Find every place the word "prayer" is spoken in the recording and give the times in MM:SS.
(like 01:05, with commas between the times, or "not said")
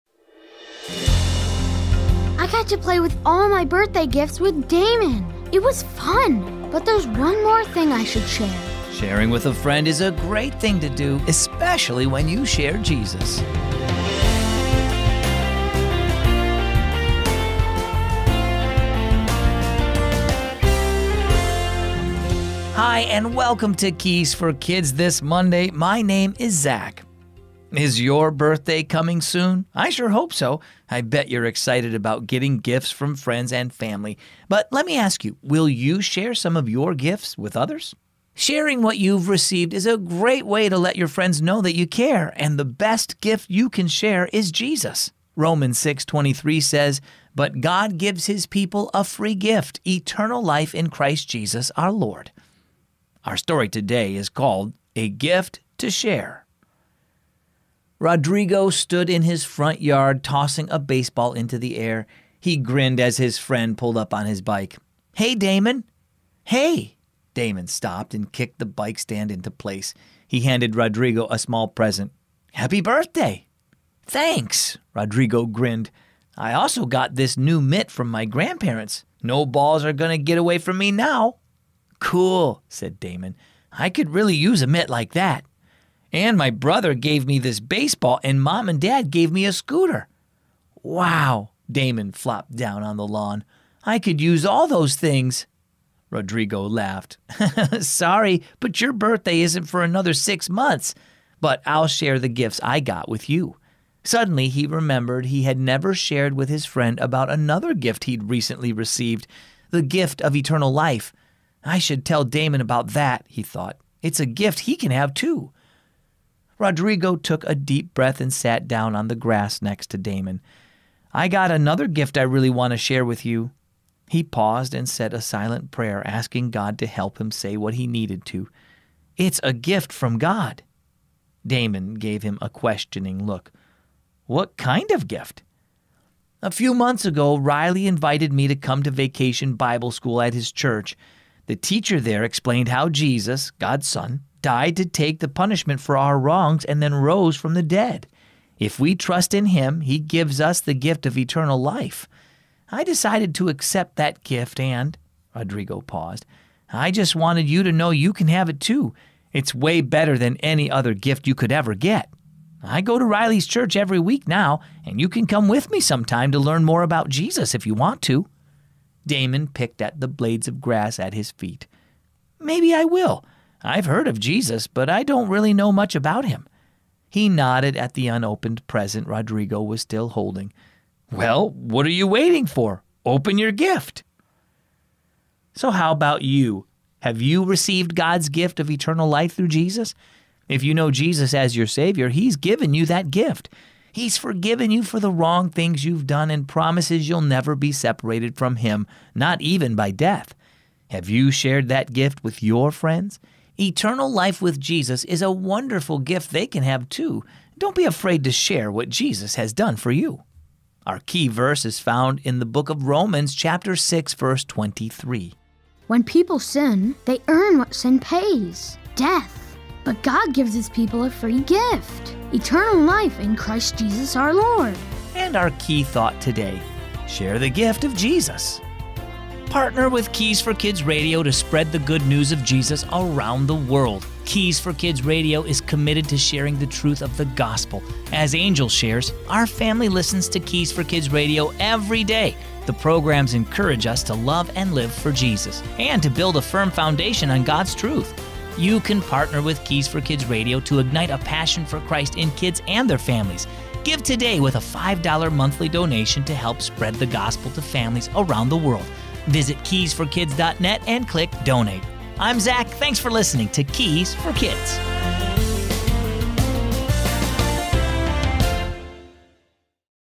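02:05.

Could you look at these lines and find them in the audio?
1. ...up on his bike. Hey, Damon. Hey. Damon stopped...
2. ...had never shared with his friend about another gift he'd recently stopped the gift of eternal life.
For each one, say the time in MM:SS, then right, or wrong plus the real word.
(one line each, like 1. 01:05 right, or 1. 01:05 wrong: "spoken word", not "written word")
1. 01:03 right
2. 01:45 wrong: "received", not "stopped".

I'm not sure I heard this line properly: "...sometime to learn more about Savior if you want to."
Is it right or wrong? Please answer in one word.
wrong.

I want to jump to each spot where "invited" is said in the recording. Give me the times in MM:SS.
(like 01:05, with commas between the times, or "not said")
02:17.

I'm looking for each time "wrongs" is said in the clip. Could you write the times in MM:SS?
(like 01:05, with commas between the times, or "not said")
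02:26, 03:15.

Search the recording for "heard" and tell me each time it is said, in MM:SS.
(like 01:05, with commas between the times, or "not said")
02:53.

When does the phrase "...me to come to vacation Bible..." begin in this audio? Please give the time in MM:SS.
02:18.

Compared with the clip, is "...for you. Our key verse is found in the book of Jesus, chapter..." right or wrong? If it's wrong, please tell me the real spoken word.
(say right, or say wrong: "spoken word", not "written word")
wrong: "Romans", not "Jesus".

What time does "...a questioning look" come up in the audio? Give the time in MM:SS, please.
02:12.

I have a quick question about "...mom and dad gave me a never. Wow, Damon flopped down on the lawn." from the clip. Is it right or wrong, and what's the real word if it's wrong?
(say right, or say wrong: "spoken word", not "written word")
wrong: "scooter", not "never".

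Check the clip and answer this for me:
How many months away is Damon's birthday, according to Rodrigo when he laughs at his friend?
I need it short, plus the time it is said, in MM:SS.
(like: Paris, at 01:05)
6, at 01:40.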